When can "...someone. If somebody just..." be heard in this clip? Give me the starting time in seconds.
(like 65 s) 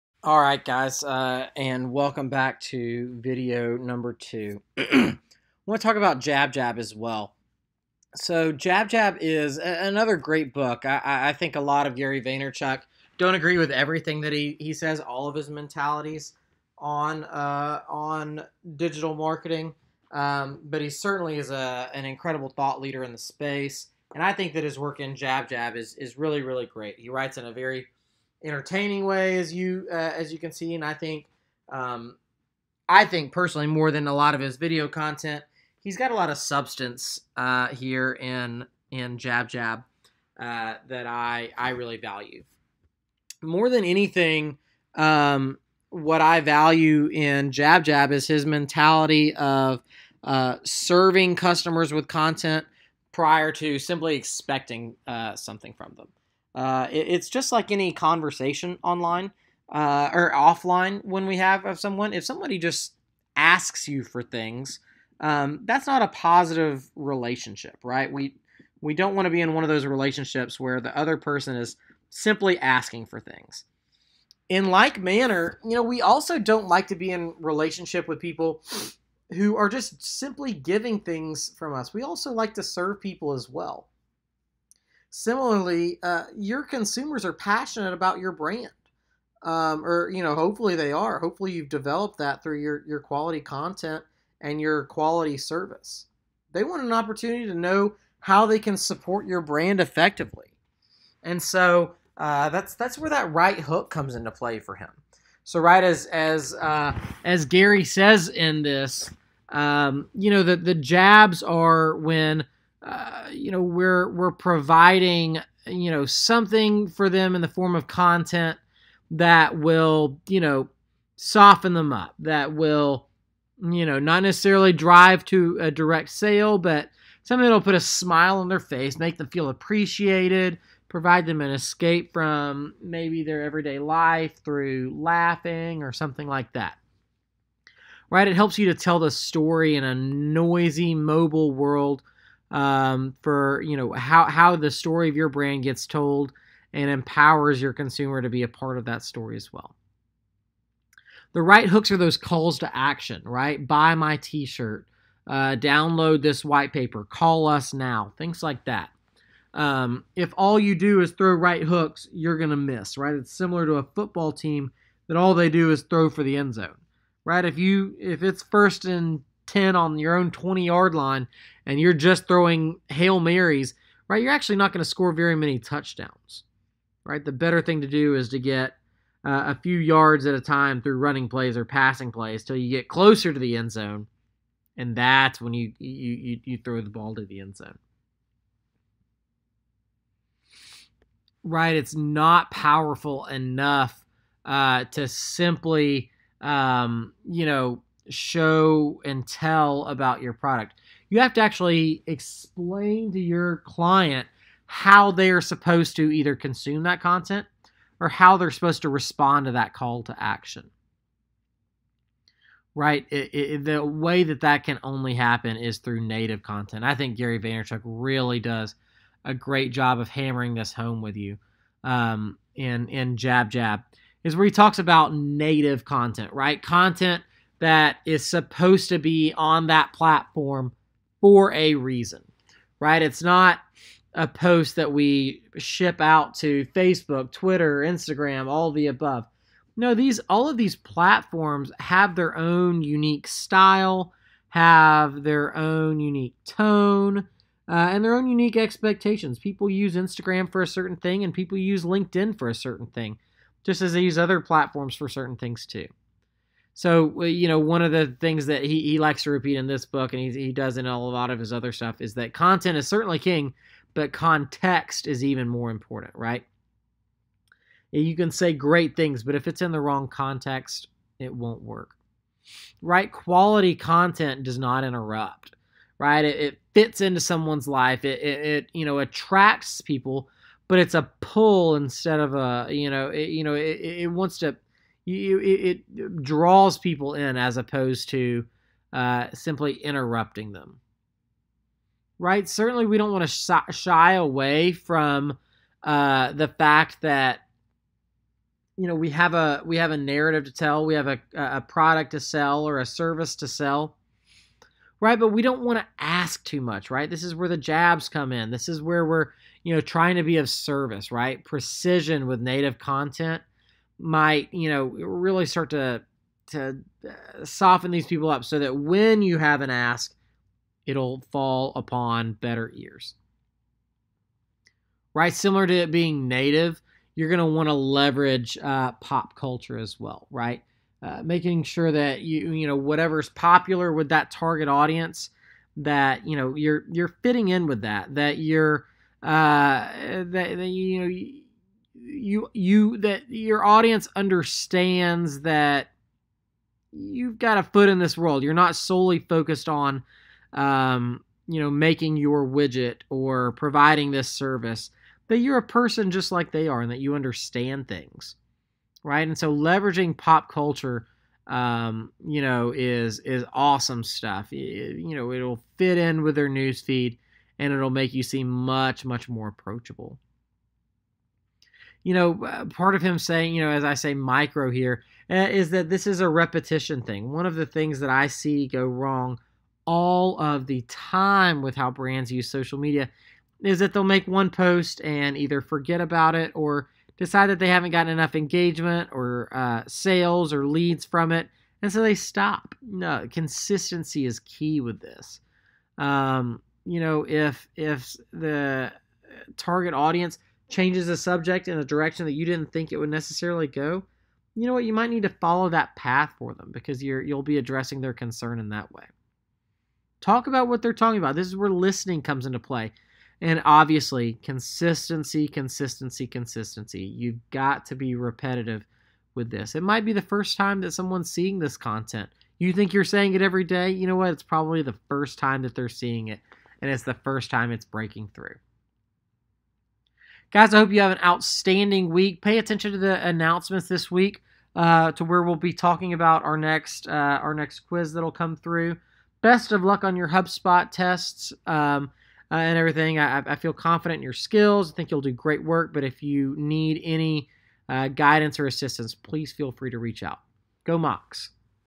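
61 s.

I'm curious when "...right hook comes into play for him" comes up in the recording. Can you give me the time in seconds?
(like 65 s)
103 s.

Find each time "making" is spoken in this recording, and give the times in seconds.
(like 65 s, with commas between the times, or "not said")
331 s, 351 s.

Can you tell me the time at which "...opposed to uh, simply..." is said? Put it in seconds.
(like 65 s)
287 s.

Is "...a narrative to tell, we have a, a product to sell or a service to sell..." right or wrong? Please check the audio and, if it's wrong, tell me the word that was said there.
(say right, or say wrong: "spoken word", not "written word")
right.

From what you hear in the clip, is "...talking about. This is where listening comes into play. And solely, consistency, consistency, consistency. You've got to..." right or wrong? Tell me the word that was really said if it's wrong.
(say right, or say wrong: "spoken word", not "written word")
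wrong: "obviously", not "solely".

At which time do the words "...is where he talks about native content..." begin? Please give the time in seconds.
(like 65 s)
224 s.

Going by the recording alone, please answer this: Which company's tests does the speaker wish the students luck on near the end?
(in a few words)
HubSpot.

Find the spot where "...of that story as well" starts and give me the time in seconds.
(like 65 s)
148 s.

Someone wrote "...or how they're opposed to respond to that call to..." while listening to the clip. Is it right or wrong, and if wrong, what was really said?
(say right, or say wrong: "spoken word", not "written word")
wrong: "supposed", not "opposed".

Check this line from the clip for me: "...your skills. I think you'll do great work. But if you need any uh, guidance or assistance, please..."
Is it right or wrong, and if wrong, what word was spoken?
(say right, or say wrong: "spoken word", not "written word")
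right.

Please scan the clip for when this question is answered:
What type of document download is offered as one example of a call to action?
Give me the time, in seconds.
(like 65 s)
156 s.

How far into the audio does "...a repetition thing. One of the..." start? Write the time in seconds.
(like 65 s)
376 s.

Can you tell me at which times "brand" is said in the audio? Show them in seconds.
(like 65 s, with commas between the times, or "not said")
88 s, 99 s, 145 s, 381 s.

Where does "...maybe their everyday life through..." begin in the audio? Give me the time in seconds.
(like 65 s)
132 s.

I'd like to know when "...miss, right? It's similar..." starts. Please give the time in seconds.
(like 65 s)
162 s.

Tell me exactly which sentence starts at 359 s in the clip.
And so leveraging pop culture um, you know, is is awesome stuff.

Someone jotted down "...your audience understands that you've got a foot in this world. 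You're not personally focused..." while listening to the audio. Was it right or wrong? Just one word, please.
wrong.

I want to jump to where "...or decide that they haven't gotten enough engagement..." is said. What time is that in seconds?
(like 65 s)
386 s.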